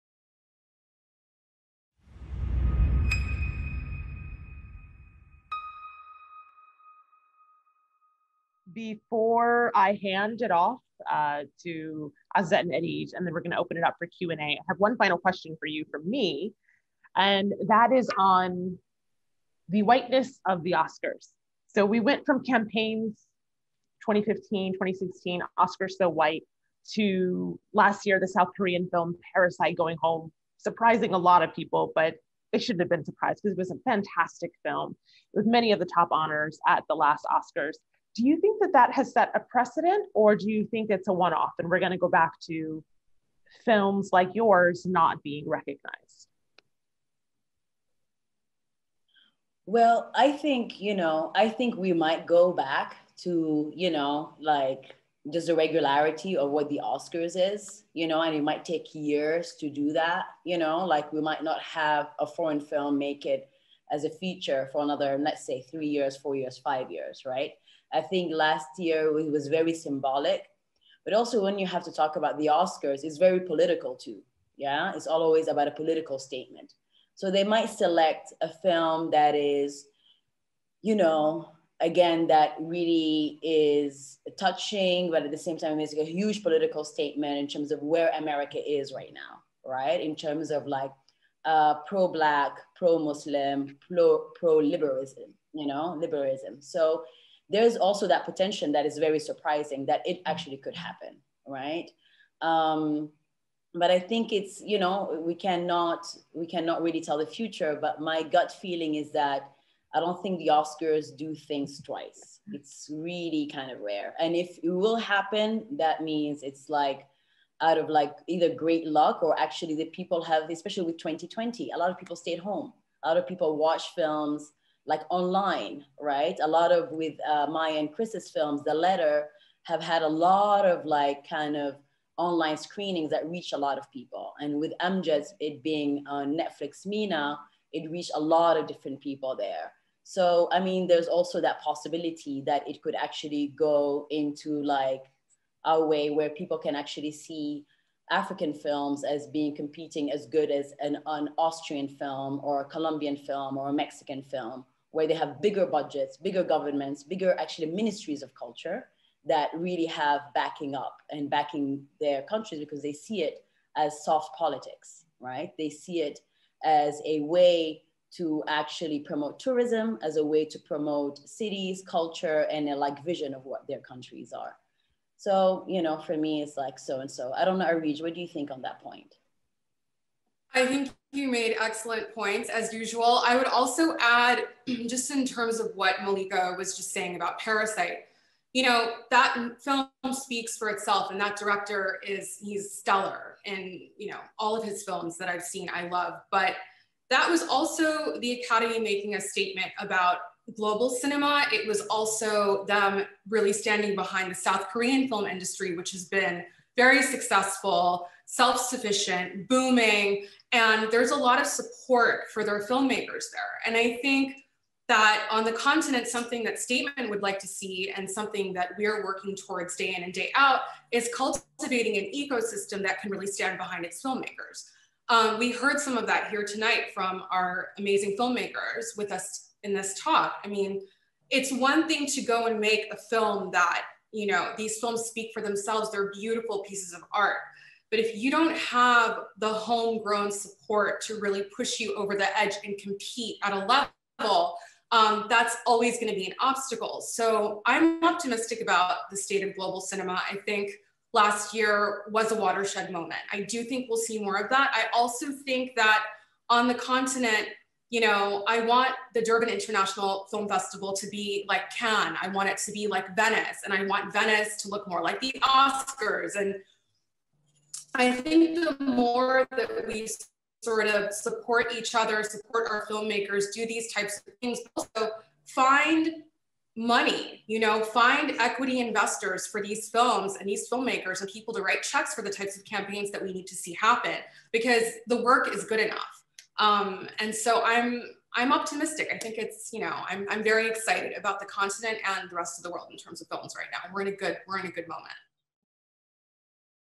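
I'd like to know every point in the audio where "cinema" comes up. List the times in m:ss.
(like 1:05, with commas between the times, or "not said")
3:20, 4:09.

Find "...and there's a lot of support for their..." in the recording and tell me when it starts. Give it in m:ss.
3:30.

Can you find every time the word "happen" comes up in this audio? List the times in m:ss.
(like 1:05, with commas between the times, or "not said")
1:40, 1:54, 4:43.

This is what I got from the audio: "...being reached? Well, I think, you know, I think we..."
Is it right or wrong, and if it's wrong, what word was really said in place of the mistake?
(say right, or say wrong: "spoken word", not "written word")
wrong: "recognized", not "reached".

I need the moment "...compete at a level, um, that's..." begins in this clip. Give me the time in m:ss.
4:02.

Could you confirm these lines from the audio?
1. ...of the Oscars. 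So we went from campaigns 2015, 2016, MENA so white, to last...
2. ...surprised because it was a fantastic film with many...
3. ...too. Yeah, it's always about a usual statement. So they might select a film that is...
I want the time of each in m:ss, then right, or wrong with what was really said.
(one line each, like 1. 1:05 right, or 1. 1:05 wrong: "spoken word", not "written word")
1. 0:20 wrong: "Oscars", not "MENA"
2. 0:33 right
3. 1:13 wrong: "political", not "usual".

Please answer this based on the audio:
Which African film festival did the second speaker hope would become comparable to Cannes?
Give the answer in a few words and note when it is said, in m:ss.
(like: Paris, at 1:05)
Durban International Film Festival, at 4:19.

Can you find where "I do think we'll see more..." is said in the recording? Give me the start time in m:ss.
4:13.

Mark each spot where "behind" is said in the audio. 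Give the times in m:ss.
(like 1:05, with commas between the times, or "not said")
3:23, 3:43.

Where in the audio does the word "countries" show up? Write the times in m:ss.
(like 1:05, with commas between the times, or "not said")
2:42, 2:53.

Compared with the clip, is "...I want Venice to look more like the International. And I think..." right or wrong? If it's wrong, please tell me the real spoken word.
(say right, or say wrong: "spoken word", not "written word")
wrong: "Oscars", not "International".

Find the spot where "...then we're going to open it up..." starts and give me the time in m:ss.
0:13.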